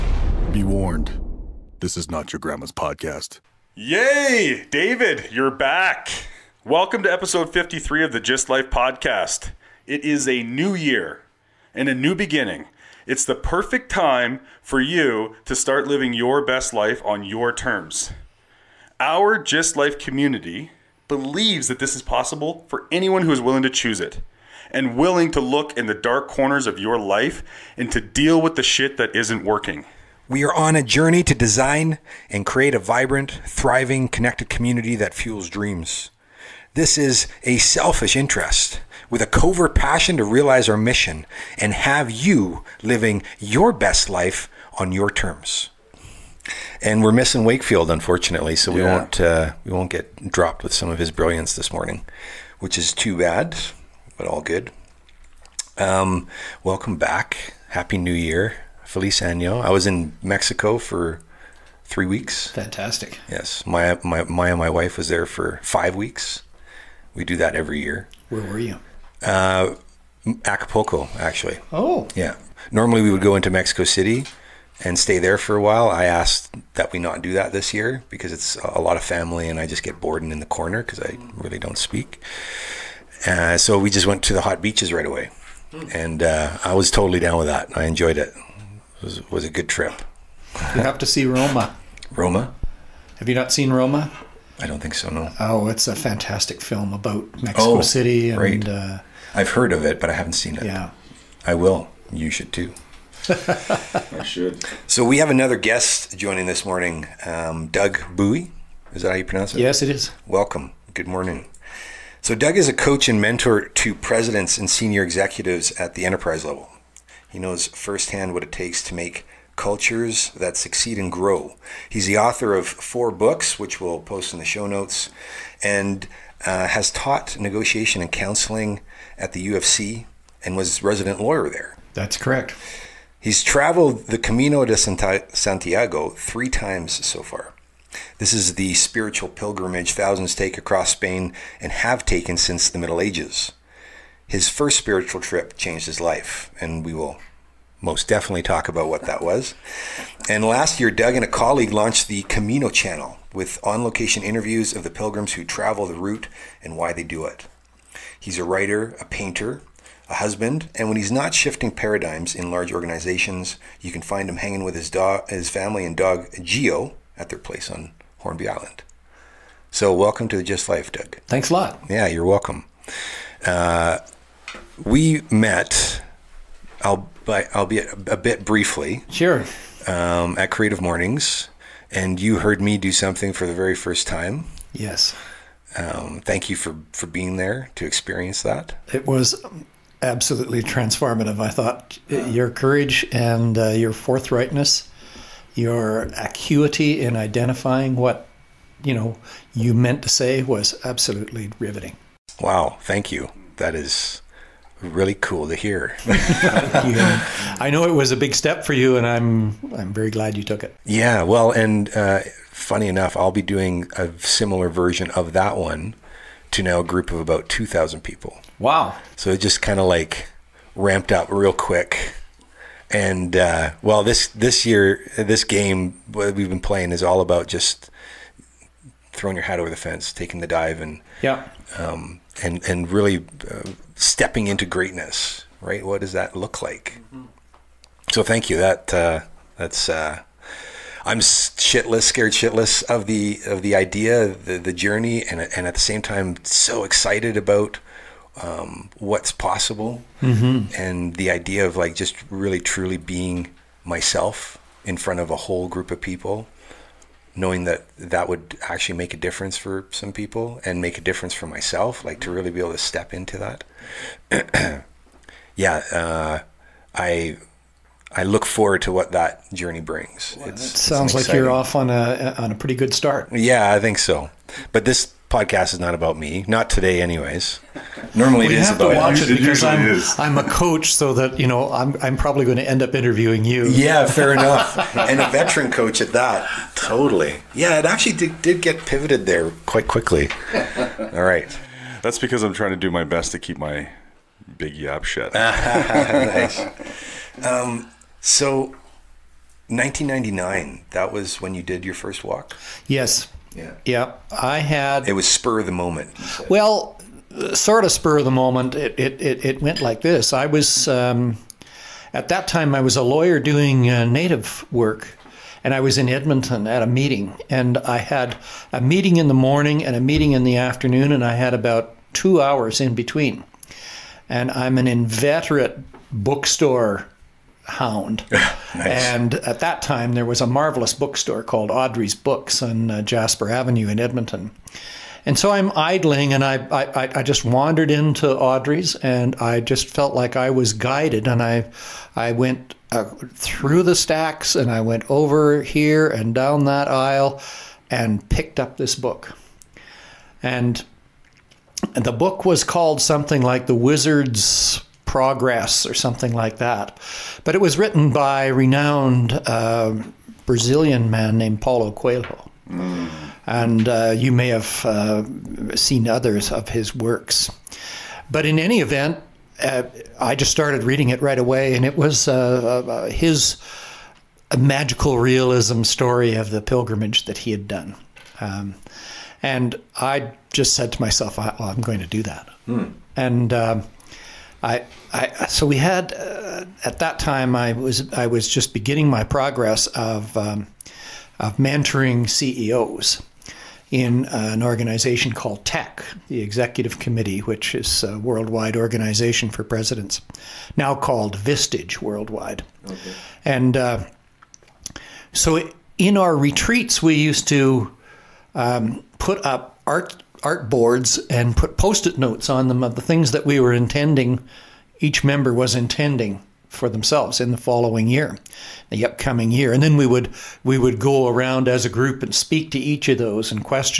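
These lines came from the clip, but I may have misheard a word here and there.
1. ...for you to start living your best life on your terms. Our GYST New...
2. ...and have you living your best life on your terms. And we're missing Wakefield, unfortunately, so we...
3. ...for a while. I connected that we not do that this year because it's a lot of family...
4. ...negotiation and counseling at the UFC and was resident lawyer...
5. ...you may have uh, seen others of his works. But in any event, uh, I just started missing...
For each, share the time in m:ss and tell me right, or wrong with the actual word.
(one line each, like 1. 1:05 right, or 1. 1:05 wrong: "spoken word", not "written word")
1. 0:14 wrong: "Life", not "New"
2. 0:41 right
3. 1:15 wrong: "asked", not "connected"
4. 2:07 right
5. 6:04 wrong: "reading", not "missing".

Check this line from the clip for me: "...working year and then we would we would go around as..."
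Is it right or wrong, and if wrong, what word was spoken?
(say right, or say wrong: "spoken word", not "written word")
wrong: "upcoming", not "working".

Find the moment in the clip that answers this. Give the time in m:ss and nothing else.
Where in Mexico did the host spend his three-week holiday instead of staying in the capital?
1:10.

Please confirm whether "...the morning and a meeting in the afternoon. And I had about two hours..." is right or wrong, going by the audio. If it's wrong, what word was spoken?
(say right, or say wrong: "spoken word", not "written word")
right.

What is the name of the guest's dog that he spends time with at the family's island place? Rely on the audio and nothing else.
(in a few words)
Geo.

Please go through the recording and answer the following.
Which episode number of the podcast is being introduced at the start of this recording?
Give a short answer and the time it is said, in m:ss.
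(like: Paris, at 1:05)
53, at 0:07.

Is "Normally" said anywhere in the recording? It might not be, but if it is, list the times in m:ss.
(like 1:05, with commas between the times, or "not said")
1:12, 4:38.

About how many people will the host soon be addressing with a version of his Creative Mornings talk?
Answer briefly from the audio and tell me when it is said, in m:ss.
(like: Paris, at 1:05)
2000, at 3:37.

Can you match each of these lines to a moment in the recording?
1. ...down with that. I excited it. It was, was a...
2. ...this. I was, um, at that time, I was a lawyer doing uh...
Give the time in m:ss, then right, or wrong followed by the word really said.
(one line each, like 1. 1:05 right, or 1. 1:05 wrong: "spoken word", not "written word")
1. 1:27 wrong: "enjoyed", not "excited"
2. 5:10 right.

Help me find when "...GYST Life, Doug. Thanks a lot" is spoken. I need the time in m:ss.
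2:50.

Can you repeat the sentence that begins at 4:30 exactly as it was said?
Well, it sounds like you're off on a on a pretty good start.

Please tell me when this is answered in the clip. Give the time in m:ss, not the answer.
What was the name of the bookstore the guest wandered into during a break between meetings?
5:31.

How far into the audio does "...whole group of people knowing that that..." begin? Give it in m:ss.
4:15.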